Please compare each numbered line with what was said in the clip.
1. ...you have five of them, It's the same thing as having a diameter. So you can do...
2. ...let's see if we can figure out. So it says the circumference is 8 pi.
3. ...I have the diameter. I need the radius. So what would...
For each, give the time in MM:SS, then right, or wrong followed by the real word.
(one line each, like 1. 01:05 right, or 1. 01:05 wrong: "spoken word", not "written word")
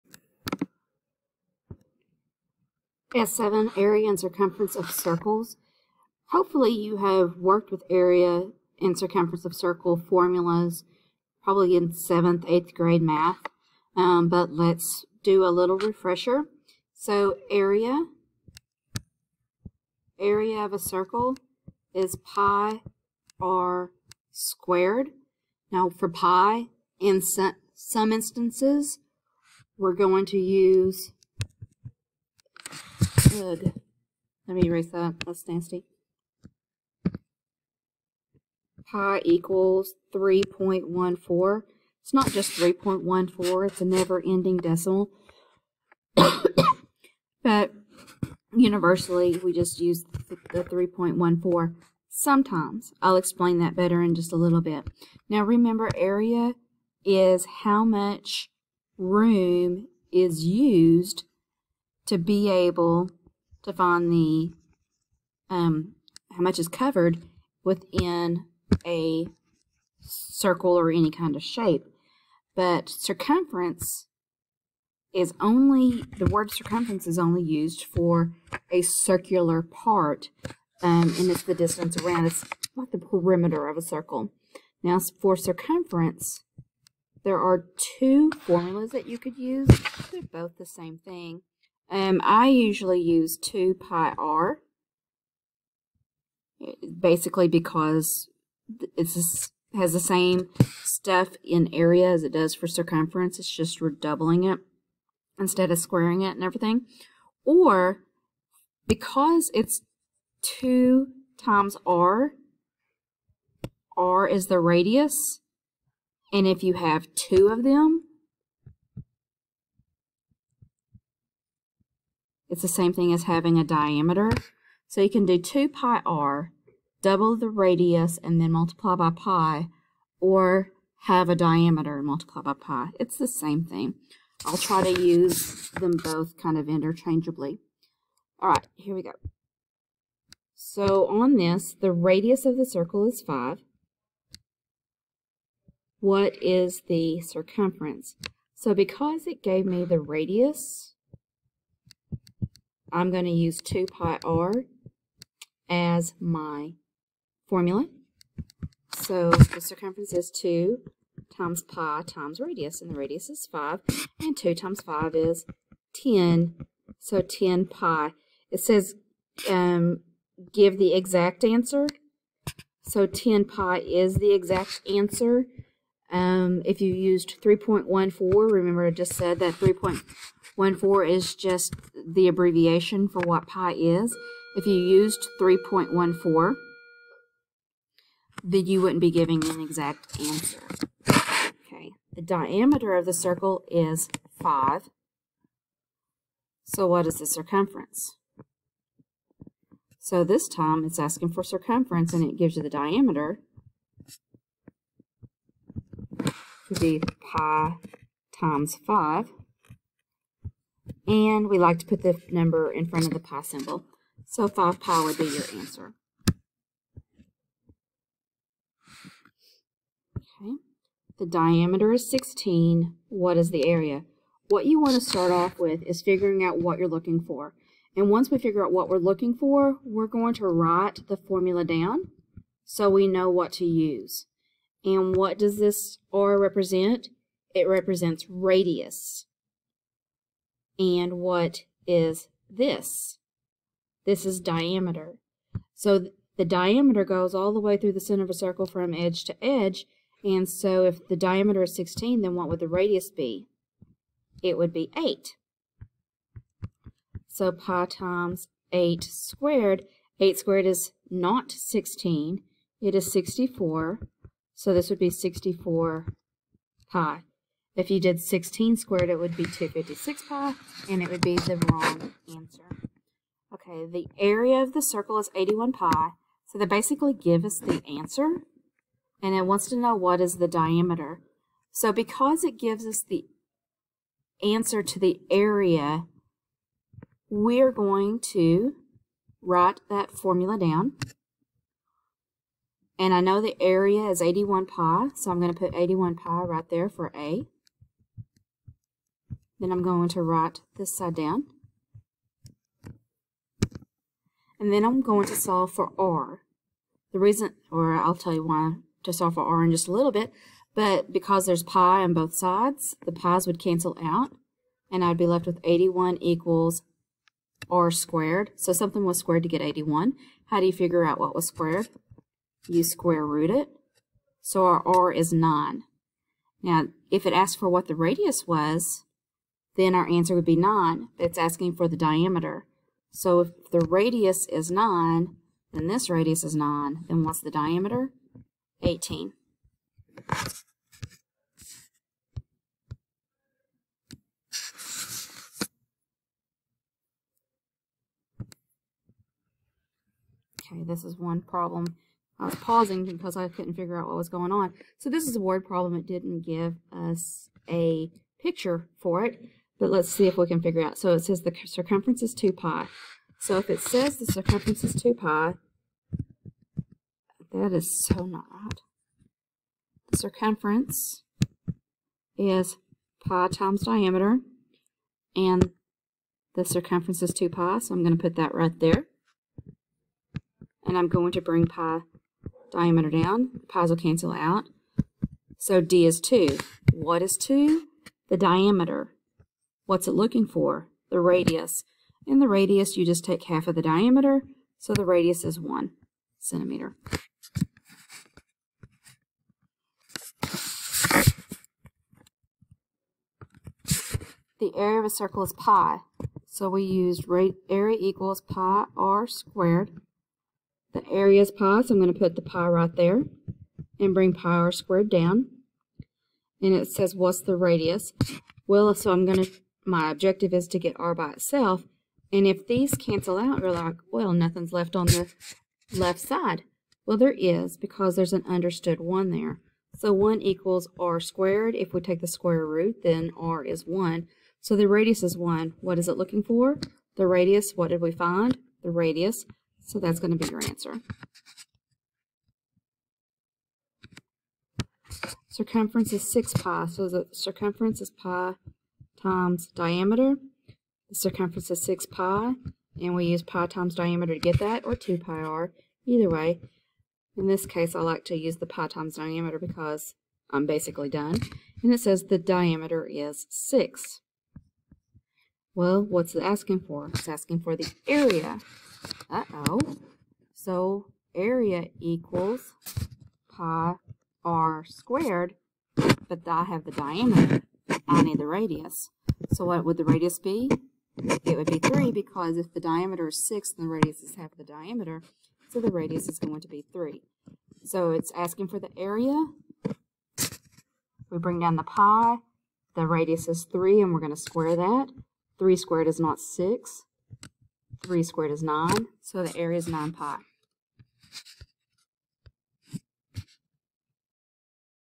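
1. 01:56 wrong: "two", not "five"
2. 05:59 wrong: "2", not "8"
3. 07:56 right.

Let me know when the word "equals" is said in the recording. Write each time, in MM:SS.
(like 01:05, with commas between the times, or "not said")
00:39, 05:16, 06:47, 07:10, 07:51.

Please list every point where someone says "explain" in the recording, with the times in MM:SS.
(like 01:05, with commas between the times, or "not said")
00:53.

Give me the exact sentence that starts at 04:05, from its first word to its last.
So th the diameter goes all the way through the center of a circle from edge to edge.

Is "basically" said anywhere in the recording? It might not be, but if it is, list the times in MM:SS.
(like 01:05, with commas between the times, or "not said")
01:36, 04:36, 07:40.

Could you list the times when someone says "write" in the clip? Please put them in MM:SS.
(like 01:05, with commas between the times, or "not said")
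03:50, 04:49, 05:00.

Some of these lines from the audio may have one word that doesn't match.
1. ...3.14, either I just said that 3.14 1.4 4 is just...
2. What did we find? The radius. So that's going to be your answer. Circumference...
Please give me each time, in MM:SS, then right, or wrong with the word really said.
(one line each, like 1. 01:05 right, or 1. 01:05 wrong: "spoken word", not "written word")
1. 02:57 wrong: "remember", not "either"
2. 07:17 right.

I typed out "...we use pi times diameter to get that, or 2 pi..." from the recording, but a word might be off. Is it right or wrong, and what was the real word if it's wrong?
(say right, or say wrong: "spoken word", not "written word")
right.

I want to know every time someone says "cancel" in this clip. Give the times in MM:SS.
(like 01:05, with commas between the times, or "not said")
05:13, 06:23, 07:02.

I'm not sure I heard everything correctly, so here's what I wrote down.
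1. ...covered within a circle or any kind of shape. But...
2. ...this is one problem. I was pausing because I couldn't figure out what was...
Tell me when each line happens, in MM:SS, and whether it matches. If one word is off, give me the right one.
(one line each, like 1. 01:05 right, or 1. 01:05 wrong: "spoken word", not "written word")
1. 01:06 right
2. 05:50 right.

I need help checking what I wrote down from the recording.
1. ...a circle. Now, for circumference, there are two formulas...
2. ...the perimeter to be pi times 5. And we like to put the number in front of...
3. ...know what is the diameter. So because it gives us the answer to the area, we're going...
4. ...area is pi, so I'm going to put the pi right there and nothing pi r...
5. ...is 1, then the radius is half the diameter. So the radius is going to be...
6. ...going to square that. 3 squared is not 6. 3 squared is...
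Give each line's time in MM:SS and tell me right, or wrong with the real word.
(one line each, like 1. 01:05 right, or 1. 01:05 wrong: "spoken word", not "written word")
1. 01:23 right
2. 03:22 wrong: "diameter", not "perimeter"
3. 04:39 right
4. 06:51 wrong: "bring", not "nothing"
5. 08:03 wrong: "6", not "1"
6. 08:14 right.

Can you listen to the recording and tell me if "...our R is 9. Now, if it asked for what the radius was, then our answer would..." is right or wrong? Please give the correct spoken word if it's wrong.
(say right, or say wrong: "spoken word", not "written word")
right.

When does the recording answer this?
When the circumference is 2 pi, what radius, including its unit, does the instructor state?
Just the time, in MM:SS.
06:35.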